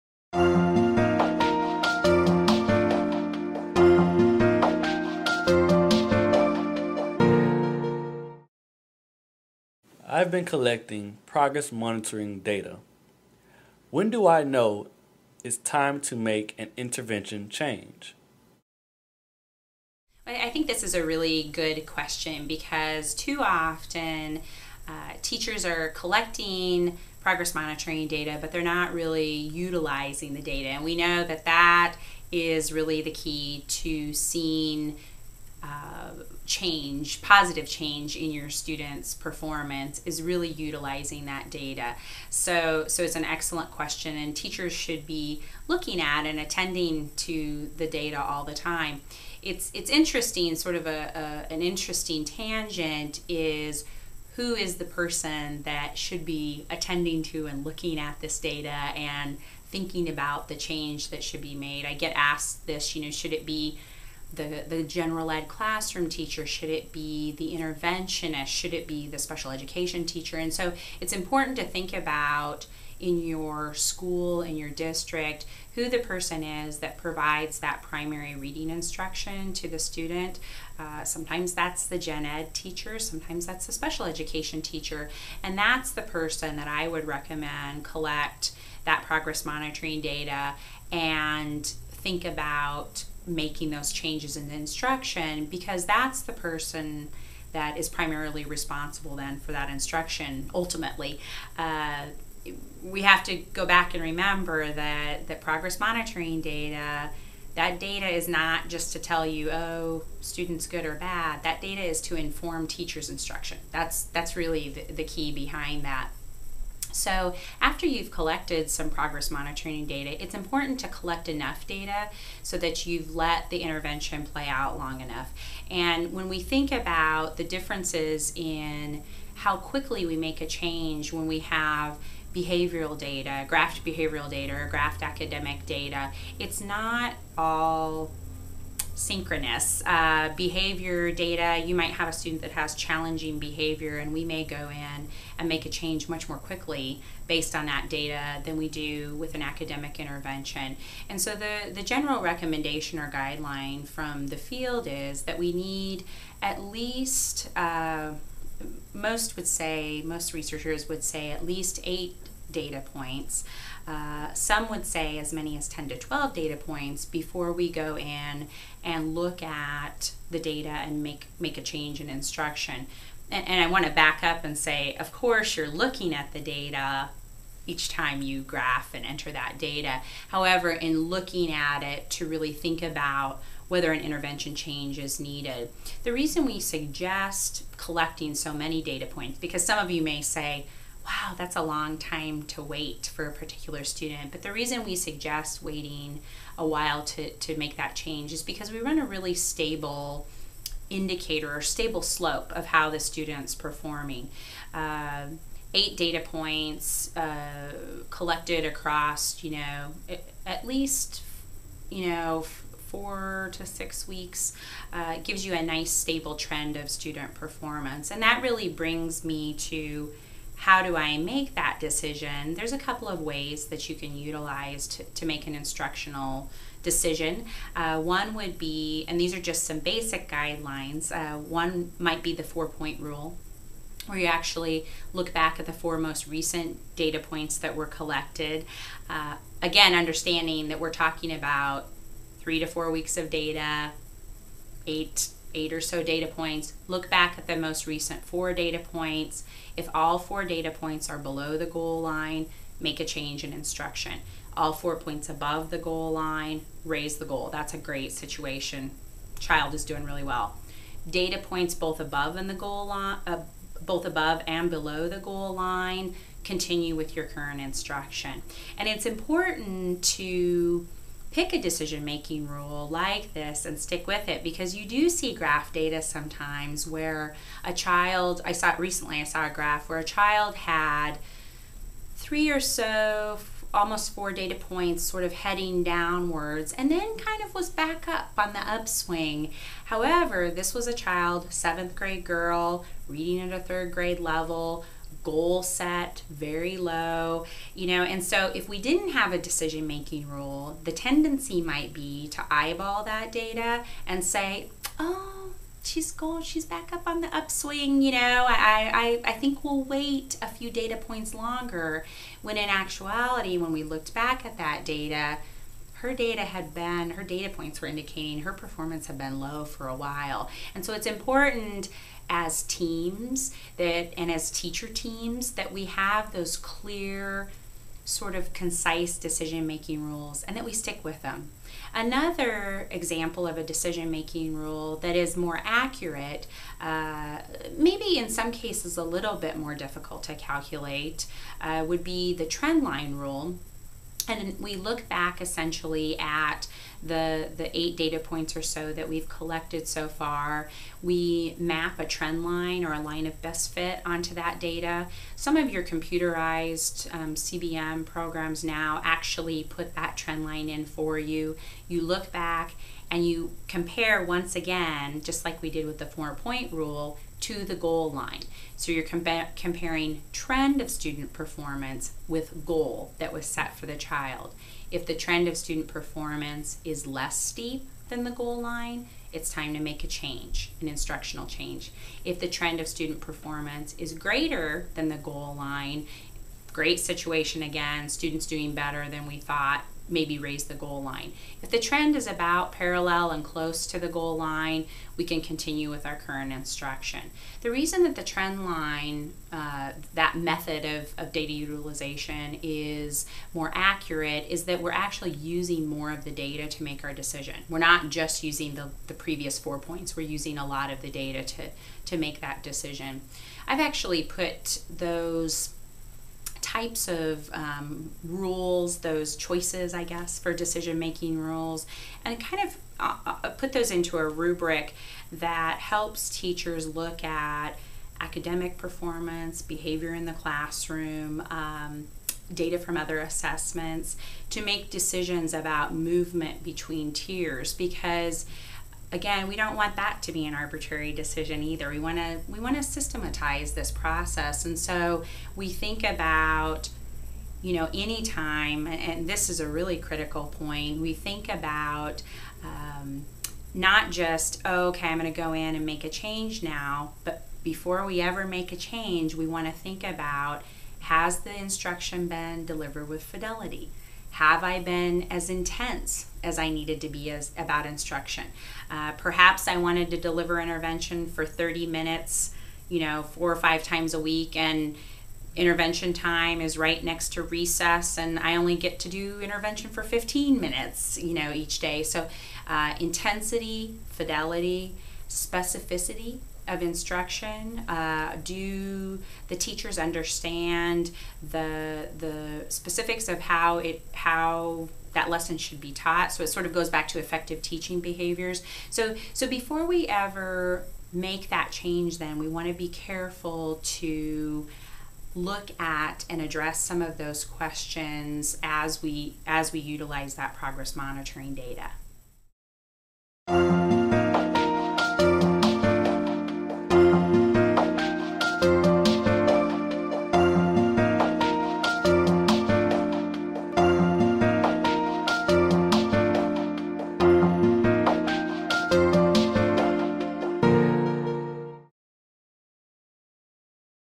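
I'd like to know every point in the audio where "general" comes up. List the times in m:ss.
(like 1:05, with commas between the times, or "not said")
1:04, 2:31.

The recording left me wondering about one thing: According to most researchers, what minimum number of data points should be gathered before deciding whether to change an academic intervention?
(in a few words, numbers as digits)
8.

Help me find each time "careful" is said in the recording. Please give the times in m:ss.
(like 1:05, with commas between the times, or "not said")
8:22.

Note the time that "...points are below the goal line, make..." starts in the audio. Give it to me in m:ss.
4:10.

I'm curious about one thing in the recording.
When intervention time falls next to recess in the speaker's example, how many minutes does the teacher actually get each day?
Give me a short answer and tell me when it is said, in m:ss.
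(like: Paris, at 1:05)
15, at 8:00.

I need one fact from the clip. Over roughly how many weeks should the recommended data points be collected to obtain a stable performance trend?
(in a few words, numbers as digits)
4 to 6 weeks.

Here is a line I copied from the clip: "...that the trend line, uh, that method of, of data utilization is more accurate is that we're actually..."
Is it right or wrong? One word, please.
right.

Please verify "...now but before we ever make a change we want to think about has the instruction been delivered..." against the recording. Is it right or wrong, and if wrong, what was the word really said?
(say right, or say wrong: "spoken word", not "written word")
right.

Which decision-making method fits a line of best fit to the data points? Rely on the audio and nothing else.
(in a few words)
trend line rule.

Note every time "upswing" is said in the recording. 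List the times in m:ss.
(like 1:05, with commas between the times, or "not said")
4:48, 5:07.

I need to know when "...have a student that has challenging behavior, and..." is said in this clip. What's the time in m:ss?
2:21.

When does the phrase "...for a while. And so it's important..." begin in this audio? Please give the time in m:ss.
5:19.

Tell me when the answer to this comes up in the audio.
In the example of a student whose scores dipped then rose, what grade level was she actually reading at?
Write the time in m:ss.
4:53.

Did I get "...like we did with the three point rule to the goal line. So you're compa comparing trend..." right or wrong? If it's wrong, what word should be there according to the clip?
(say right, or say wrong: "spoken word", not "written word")
wrong: "four", not "three".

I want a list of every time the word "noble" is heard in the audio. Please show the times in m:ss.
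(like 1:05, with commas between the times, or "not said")
not said.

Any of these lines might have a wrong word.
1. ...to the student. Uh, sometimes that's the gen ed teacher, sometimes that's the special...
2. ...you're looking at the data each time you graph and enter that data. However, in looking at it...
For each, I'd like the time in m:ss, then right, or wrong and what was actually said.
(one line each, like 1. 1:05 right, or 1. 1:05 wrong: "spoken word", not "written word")
1. 1:19 right
2. 2:55 right.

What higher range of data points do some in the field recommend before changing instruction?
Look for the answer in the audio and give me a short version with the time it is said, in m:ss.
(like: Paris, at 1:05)
10 to 12, at 2:45.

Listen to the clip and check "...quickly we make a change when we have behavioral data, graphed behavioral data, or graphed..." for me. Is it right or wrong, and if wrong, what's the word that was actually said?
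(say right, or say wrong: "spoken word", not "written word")
right.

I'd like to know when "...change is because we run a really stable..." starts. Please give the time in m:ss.
3:17.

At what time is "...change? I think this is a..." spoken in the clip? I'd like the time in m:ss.
0:17.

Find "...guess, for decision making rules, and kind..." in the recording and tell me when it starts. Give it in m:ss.
7:00.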